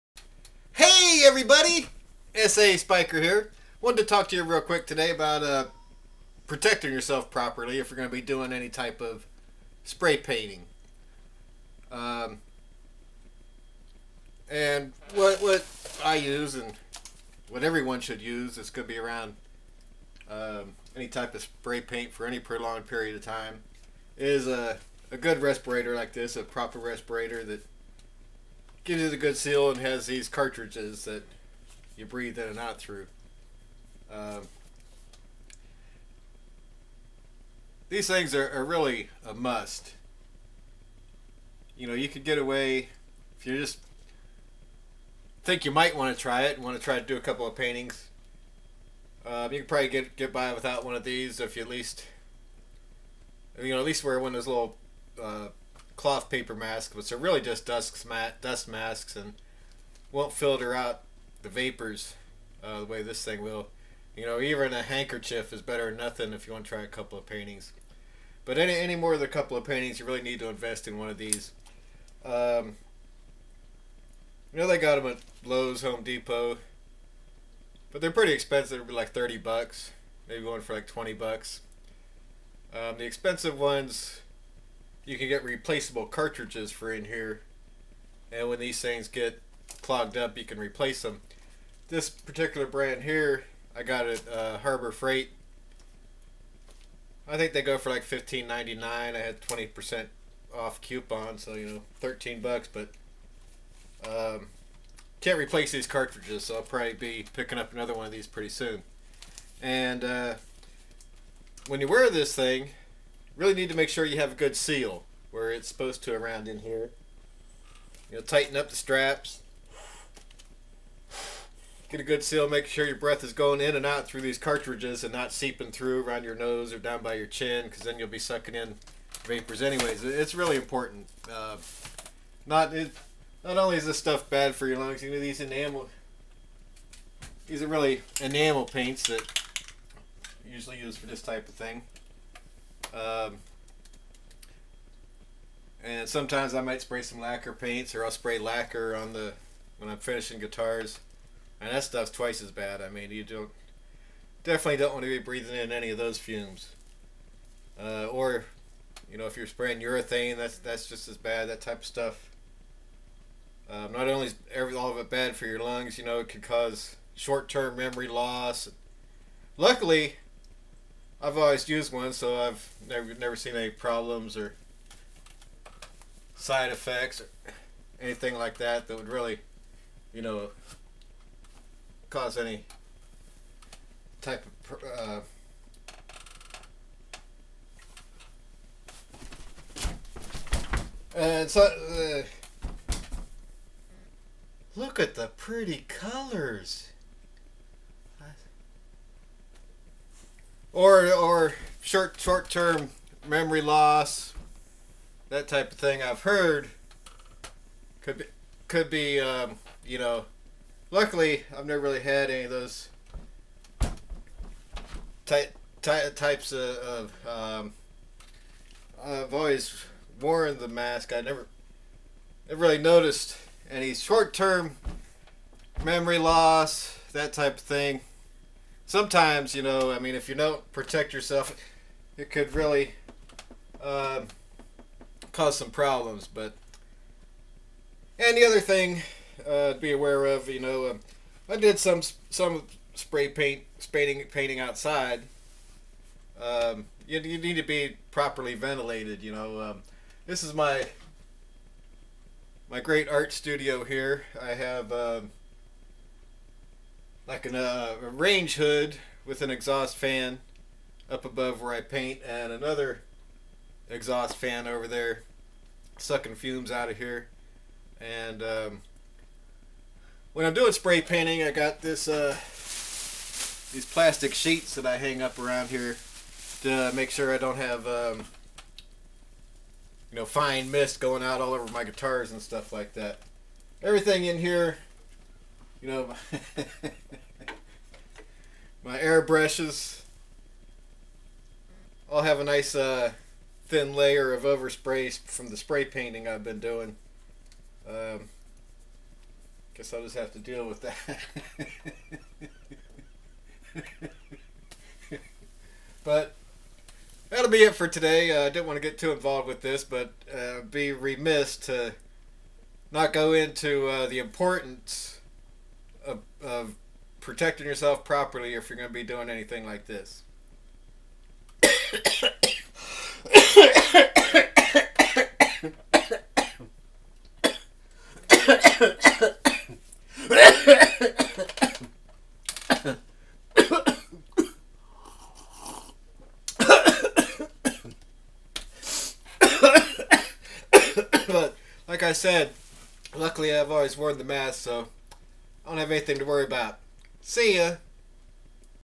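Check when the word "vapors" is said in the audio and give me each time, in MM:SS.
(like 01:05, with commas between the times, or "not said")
01:01, 02:09.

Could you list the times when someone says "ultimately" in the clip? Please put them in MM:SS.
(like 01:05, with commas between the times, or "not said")
not said.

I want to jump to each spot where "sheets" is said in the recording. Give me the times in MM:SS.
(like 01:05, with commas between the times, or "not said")
04:34.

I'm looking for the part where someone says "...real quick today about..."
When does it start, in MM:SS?
00:04.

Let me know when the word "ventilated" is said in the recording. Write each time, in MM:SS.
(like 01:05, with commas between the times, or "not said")
04:08.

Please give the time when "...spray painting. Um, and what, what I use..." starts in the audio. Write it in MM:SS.
00:09.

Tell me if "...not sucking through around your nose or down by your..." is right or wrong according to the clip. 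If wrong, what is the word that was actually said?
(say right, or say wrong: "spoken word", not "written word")
wrong: "seeping", not "sucking".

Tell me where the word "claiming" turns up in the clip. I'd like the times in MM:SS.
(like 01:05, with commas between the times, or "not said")
not said.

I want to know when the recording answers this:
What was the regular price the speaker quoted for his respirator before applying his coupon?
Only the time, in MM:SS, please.
01:38.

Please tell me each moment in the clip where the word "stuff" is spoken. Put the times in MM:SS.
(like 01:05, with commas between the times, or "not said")
02:13, 02:31, 02:41, 04:42.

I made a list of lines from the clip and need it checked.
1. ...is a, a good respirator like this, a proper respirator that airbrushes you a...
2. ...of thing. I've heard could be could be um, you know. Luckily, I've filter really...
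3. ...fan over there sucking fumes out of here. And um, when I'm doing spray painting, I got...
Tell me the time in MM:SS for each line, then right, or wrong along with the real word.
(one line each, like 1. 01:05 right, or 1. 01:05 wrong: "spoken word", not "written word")
1. 00:24 wrong: "gives", not "airbrushes"
2. 03:25 wrong: "never", not "filter"
3. 04:24 right.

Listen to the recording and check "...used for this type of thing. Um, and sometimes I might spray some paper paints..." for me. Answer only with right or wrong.
wrong.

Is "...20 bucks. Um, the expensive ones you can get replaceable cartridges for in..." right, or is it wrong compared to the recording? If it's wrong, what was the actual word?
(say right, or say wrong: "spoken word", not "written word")
right.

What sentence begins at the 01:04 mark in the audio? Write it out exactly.
You know, even a handkerchief is better than nothing if you want to try a couple of paintings.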